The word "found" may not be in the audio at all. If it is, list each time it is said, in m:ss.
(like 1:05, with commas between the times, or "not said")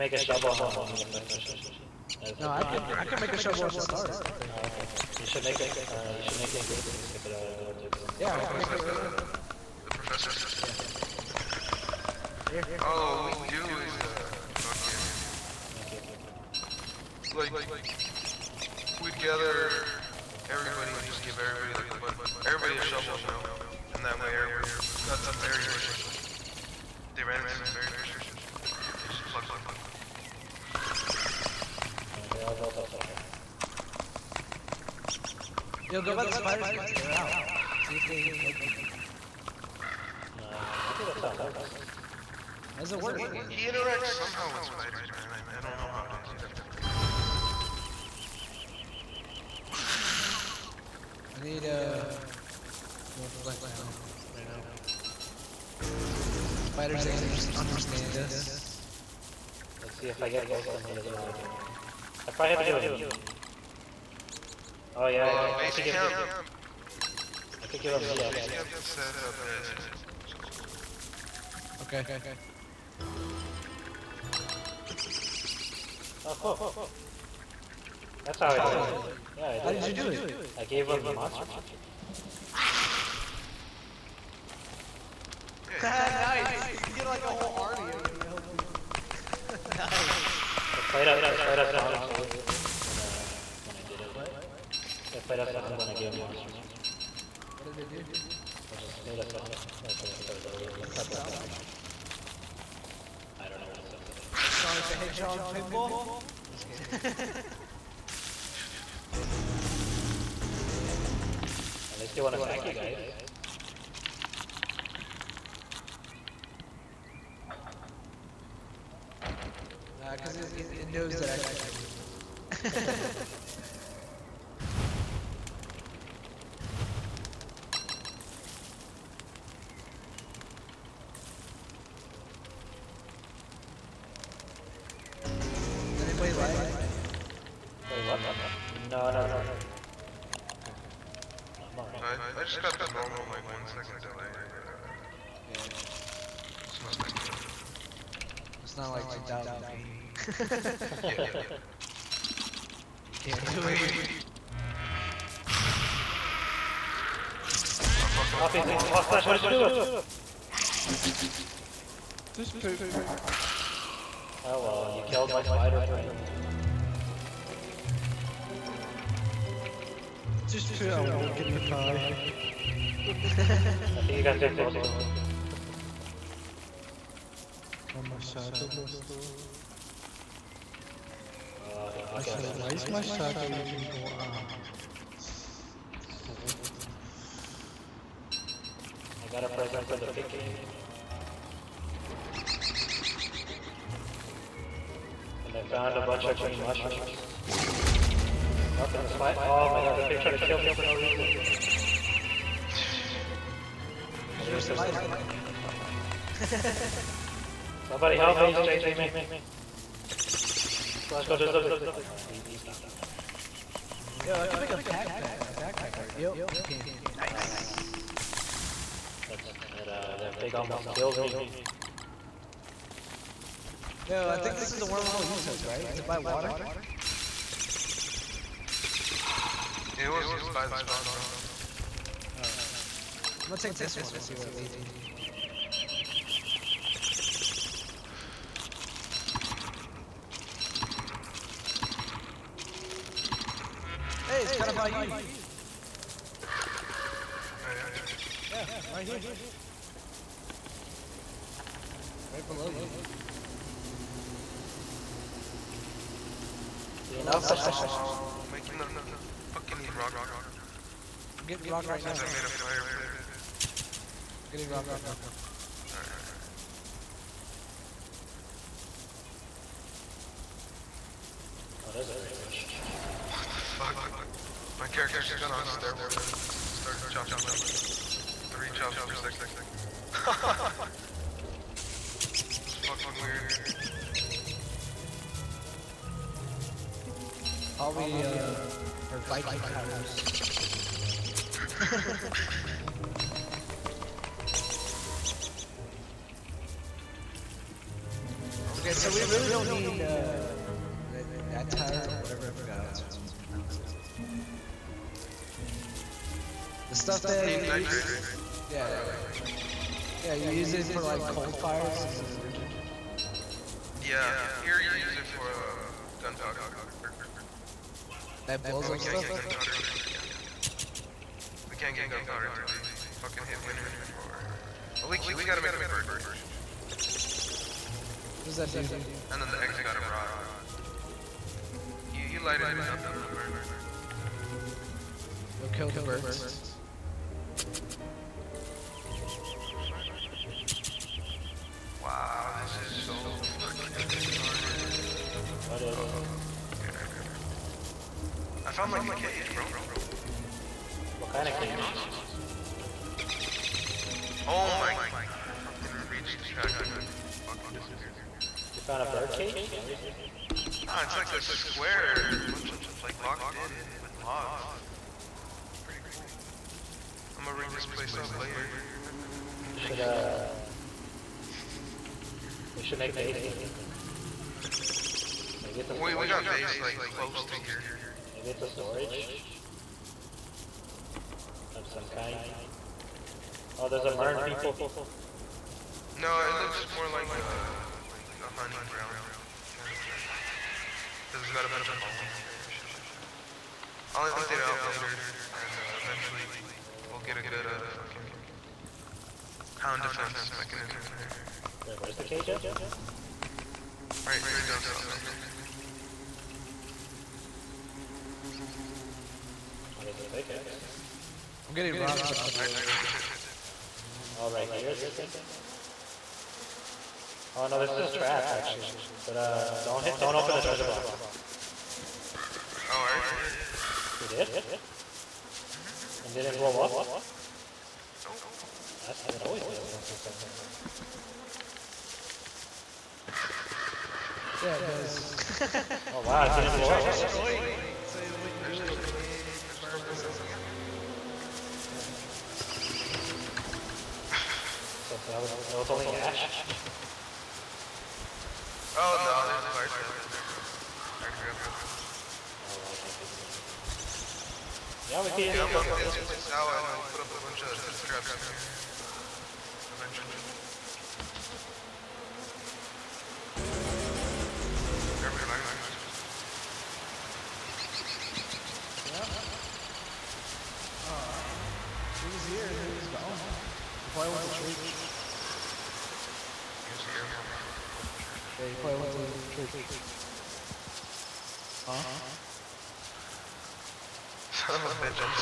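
3:15, 5:48, 5:58.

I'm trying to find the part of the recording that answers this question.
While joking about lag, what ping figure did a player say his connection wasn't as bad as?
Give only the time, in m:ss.
2:29.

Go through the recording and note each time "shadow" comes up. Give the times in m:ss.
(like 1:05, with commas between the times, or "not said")
2:58, 3:03.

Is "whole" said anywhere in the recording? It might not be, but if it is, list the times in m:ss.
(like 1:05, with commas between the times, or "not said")
1:27.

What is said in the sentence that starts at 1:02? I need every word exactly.
I probably have to give him meat.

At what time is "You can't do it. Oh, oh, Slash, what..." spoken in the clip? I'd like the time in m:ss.
2:33.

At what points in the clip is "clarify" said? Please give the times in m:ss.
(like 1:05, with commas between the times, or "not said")
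not said.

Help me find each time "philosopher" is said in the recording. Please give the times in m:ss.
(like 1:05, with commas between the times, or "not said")
not said.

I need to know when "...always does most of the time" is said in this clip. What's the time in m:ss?
7:09.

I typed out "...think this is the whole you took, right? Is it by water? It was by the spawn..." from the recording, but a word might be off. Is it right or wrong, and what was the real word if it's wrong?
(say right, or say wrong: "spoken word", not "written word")
wrong: "wormhole", not "whole".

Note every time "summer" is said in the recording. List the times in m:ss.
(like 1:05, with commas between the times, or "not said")
not said.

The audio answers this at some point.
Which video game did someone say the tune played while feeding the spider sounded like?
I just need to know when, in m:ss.
1:44.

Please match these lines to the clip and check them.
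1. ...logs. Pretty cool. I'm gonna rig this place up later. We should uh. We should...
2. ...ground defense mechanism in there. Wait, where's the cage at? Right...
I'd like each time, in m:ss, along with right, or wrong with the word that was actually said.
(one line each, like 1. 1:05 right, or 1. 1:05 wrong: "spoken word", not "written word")
1. 6:04 right
2. 6:39 wrong: "hound", not "ground".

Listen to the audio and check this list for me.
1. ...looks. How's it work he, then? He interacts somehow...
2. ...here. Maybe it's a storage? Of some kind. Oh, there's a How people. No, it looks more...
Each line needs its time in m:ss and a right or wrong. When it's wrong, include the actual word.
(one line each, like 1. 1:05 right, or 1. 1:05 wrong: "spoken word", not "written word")
1. 0:41 wrong: "works", not "looks"
2. 6:17 wrong: "Merm", not "How".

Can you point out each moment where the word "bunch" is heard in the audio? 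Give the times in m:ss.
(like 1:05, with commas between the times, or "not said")
3:16, 6:02, 6:31, 7:37.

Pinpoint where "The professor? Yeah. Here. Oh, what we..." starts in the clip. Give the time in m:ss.
0:09.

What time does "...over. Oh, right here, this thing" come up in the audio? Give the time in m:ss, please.
6:52.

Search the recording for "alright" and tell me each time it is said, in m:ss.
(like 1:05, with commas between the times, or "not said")
2:21, 4:25.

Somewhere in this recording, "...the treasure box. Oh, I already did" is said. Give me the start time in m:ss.
7:00.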